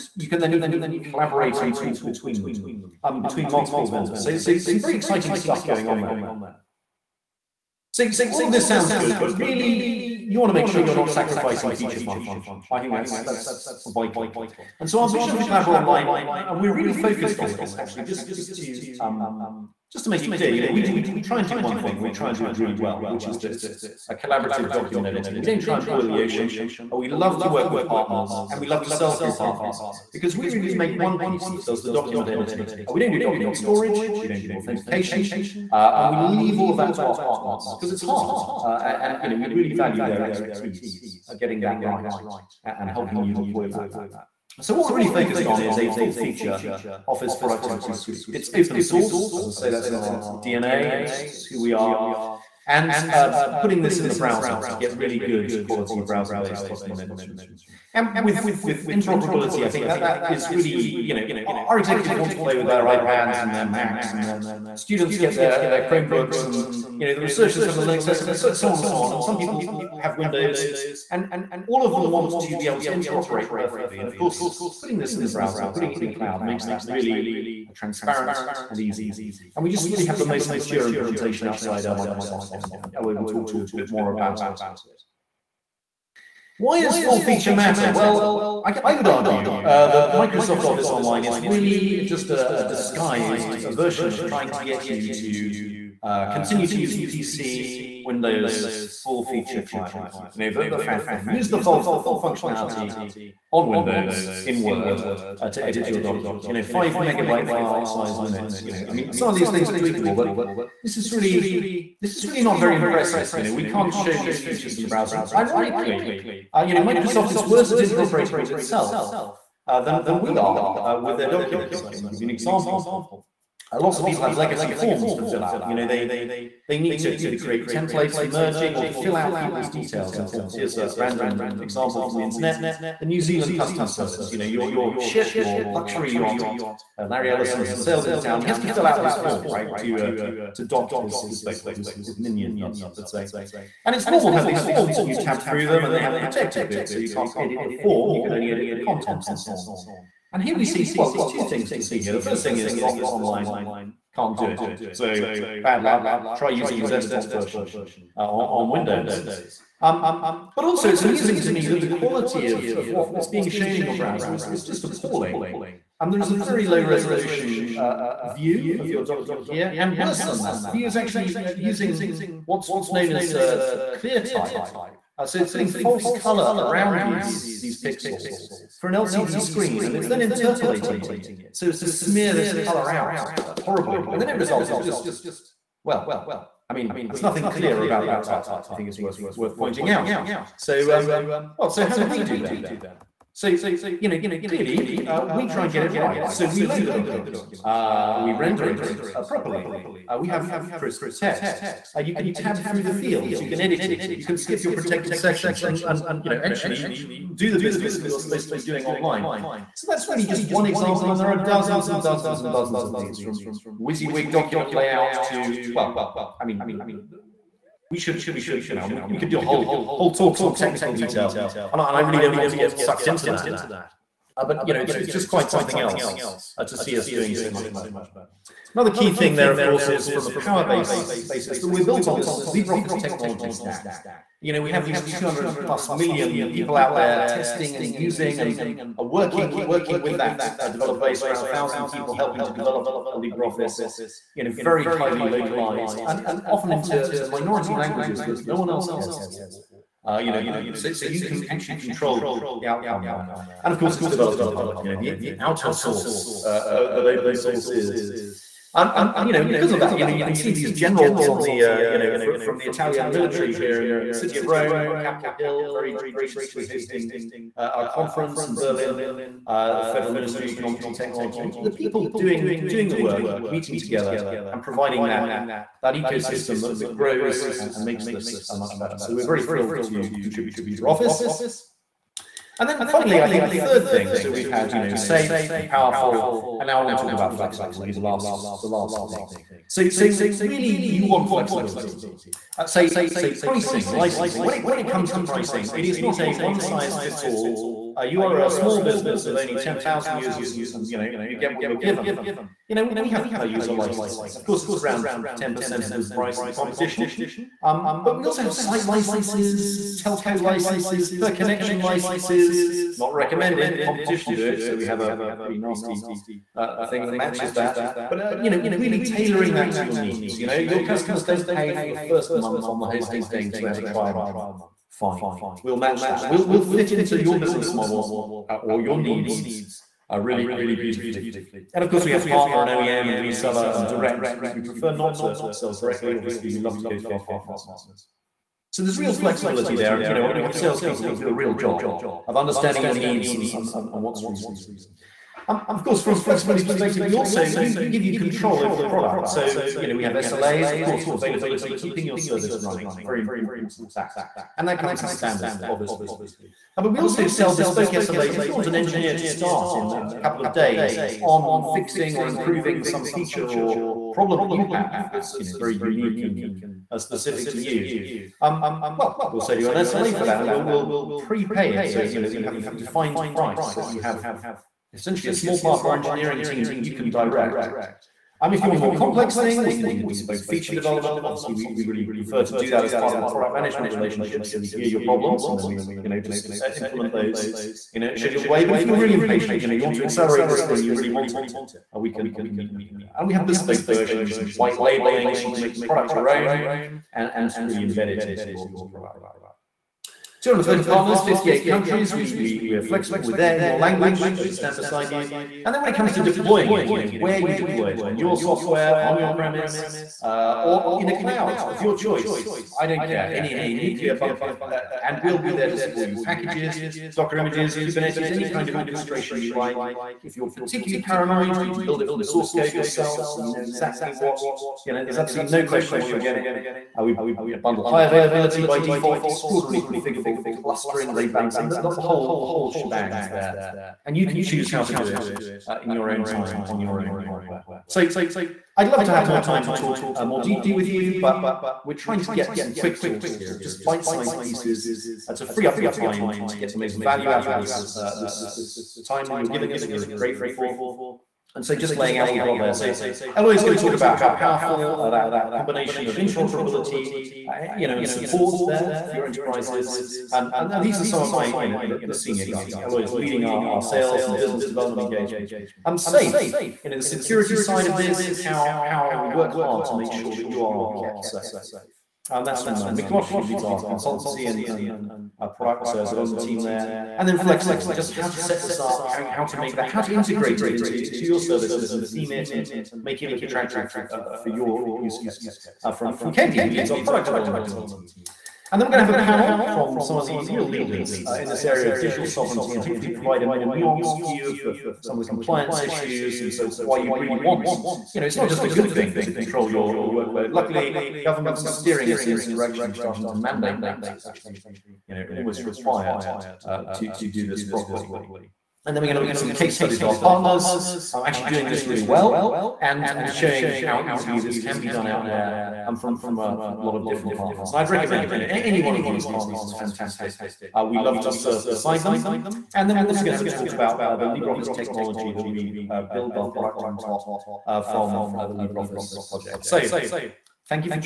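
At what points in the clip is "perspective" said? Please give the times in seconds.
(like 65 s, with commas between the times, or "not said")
346 s.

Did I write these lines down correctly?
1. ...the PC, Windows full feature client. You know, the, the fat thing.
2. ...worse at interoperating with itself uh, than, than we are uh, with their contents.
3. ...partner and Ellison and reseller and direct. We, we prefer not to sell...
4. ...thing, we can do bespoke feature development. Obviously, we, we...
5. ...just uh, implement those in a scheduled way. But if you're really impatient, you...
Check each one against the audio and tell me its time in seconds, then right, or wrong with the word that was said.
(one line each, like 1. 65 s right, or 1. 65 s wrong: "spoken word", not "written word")
1. 96 s right
2. 117 s wrong: "documents", not "contents"
3. 332 s wrong: "OEM", not "Ellison"
4. 379 s right
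5. 386 s right.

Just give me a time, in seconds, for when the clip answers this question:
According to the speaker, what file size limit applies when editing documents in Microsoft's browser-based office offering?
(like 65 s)
106 s.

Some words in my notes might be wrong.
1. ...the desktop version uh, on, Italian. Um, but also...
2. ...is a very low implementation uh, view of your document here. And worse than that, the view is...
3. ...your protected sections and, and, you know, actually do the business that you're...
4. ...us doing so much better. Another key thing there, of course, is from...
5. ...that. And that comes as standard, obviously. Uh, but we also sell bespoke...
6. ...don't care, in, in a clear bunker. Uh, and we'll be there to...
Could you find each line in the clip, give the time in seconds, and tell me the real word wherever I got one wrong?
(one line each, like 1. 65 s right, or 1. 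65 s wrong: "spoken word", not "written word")
1. 156 s wrong: "Windows", not "Italian"
2. 166 s wrong: "resolution", not "implementation"
3. 204 s right
4. 226 s right
5. 353 s right
6. 412 s wrong: "nuclear", not "clear".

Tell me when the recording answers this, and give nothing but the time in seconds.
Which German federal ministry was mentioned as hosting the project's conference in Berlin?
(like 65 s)
269 s.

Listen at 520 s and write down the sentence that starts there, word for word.
Uh, we love to serve beside them.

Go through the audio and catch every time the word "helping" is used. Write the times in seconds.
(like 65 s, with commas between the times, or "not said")
42 s, 242 s.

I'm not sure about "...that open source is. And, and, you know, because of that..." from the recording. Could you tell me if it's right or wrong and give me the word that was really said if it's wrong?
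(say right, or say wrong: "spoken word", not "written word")
right.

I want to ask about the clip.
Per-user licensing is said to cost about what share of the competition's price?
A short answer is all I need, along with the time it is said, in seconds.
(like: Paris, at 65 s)
10%, at 305 s.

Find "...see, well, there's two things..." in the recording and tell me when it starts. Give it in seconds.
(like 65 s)
150 s.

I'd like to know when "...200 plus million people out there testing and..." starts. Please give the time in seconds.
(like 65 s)
235 s.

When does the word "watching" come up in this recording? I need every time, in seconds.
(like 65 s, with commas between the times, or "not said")
not said.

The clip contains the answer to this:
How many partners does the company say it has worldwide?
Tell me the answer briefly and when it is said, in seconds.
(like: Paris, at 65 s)
230, at 400 s.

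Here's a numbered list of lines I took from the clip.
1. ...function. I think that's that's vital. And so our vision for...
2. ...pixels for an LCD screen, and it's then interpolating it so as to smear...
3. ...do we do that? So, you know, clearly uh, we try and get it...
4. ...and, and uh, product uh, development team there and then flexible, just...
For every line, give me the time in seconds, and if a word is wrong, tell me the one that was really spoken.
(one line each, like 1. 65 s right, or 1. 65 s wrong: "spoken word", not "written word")
1. 12 s right
2. 177 s right
3. 191 s right
4. 474 s right.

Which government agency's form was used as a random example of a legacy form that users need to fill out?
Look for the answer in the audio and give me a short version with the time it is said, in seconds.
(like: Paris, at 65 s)
New Zealand Customs Service, at 133 s.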